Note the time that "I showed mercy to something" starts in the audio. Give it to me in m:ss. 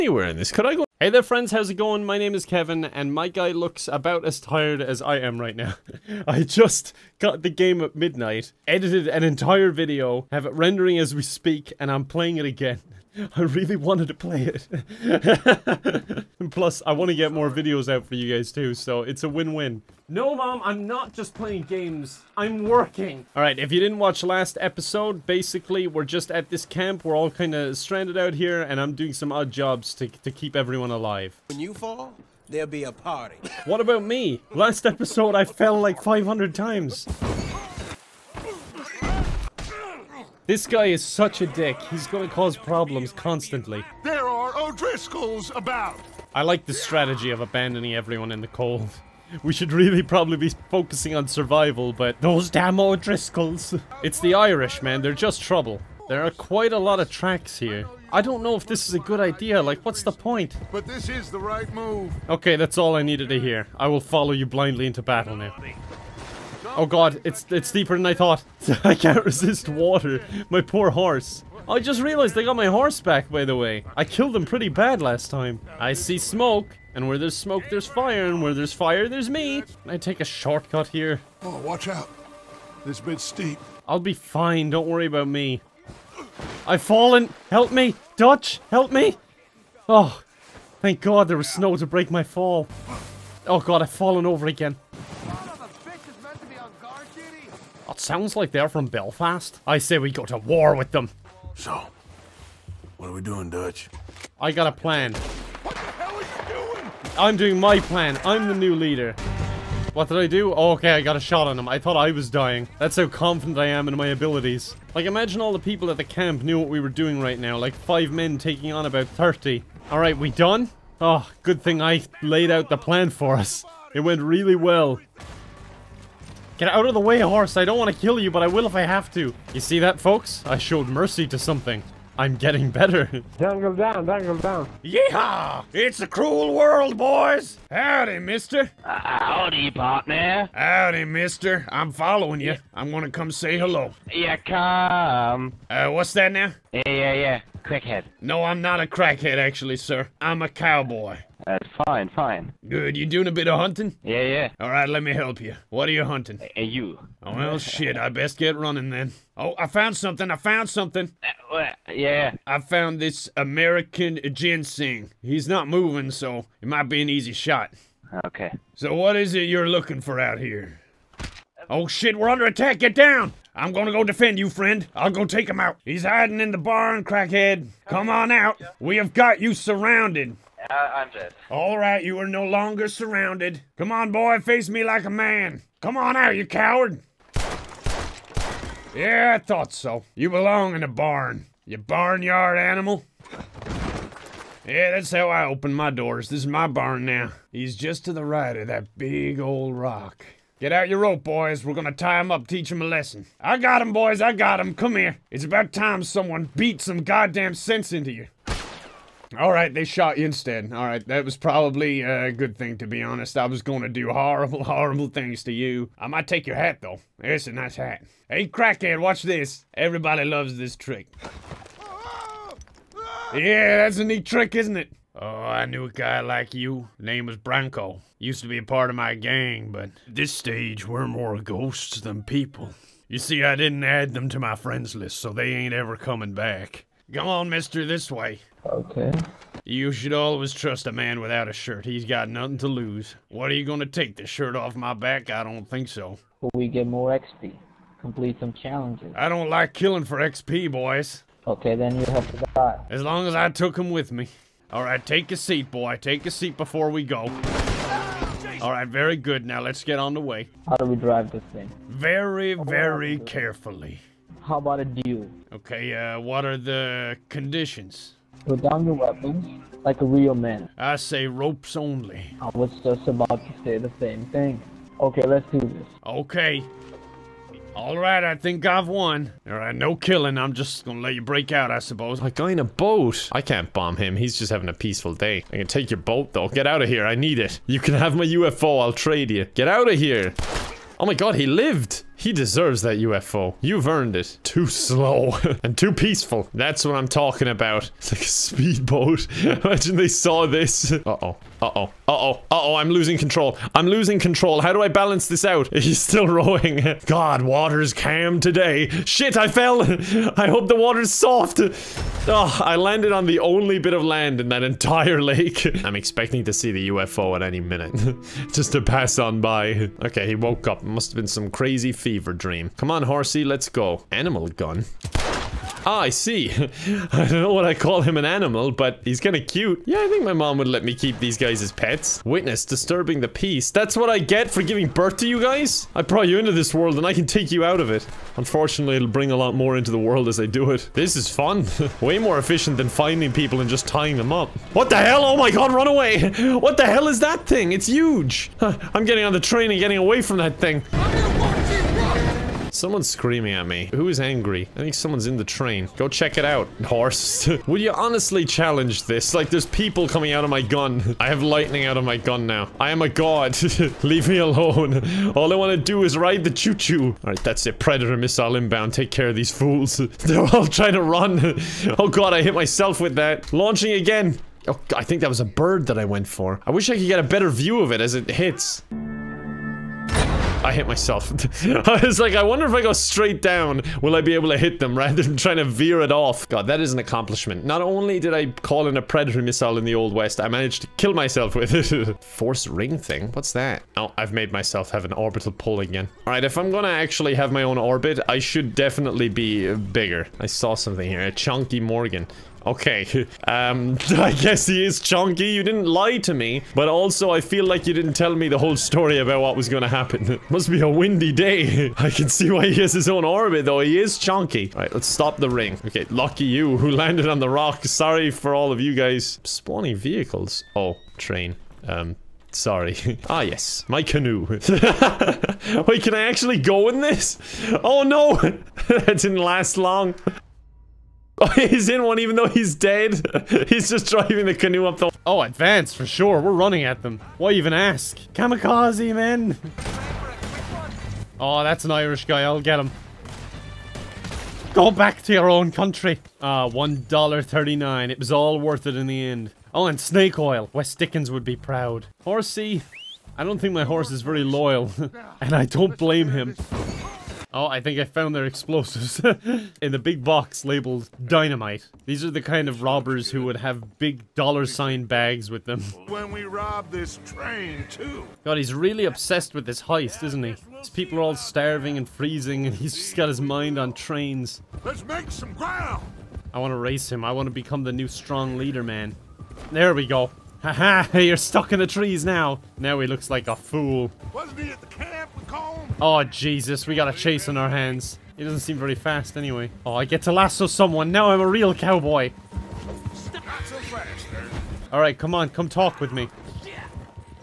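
2:10.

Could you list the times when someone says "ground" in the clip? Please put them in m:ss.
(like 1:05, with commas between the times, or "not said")
7:55.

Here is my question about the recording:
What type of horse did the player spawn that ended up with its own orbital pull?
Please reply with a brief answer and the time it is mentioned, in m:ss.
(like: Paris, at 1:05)
Chunky Morgan, at 6:41.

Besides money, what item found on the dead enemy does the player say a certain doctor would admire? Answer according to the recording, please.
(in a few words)
Snake oil.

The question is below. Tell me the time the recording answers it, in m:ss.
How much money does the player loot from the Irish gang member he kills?
7:26.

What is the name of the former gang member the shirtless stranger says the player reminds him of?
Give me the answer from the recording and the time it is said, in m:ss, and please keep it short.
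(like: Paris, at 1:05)
Branco, at 3:47.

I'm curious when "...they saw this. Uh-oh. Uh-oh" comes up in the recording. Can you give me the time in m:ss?
4:59.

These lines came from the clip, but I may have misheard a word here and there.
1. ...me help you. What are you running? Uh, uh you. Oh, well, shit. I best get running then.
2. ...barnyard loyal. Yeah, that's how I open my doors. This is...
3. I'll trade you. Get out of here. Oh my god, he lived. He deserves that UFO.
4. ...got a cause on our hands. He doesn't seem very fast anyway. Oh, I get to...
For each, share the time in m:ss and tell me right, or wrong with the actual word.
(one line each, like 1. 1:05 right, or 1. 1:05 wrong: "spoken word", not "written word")
1. 2:35 wrong: "hunting", not "running"
2. 3:11 wrong: "animal", not "loyal"
3. 4:48 right
4. 8:06 wrong: "chase", not "cause".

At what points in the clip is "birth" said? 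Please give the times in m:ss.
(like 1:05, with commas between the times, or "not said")
5:34.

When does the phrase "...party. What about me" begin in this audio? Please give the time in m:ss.
0:32.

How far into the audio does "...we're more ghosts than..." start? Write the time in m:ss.
3:50.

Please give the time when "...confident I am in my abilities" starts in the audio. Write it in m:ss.
1:53.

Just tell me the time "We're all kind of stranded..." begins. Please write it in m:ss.
0:27.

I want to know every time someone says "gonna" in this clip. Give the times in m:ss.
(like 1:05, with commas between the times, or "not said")
2:22, 2:53, 3:21, 4:03, 4:40, 6:36, 6:49.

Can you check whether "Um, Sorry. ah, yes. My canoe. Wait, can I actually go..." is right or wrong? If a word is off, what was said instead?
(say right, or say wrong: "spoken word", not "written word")
right.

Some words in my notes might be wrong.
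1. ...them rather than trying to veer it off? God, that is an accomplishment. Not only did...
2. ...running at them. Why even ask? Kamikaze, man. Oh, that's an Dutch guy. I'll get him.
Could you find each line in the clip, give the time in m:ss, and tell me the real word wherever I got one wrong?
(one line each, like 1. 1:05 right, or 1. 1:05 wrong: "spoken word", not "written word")
1. 6:24 right
2. 7:16 wrong: "Irish", not "Dutch".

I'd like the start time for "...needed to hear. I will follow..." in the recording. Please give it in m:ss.
1:03.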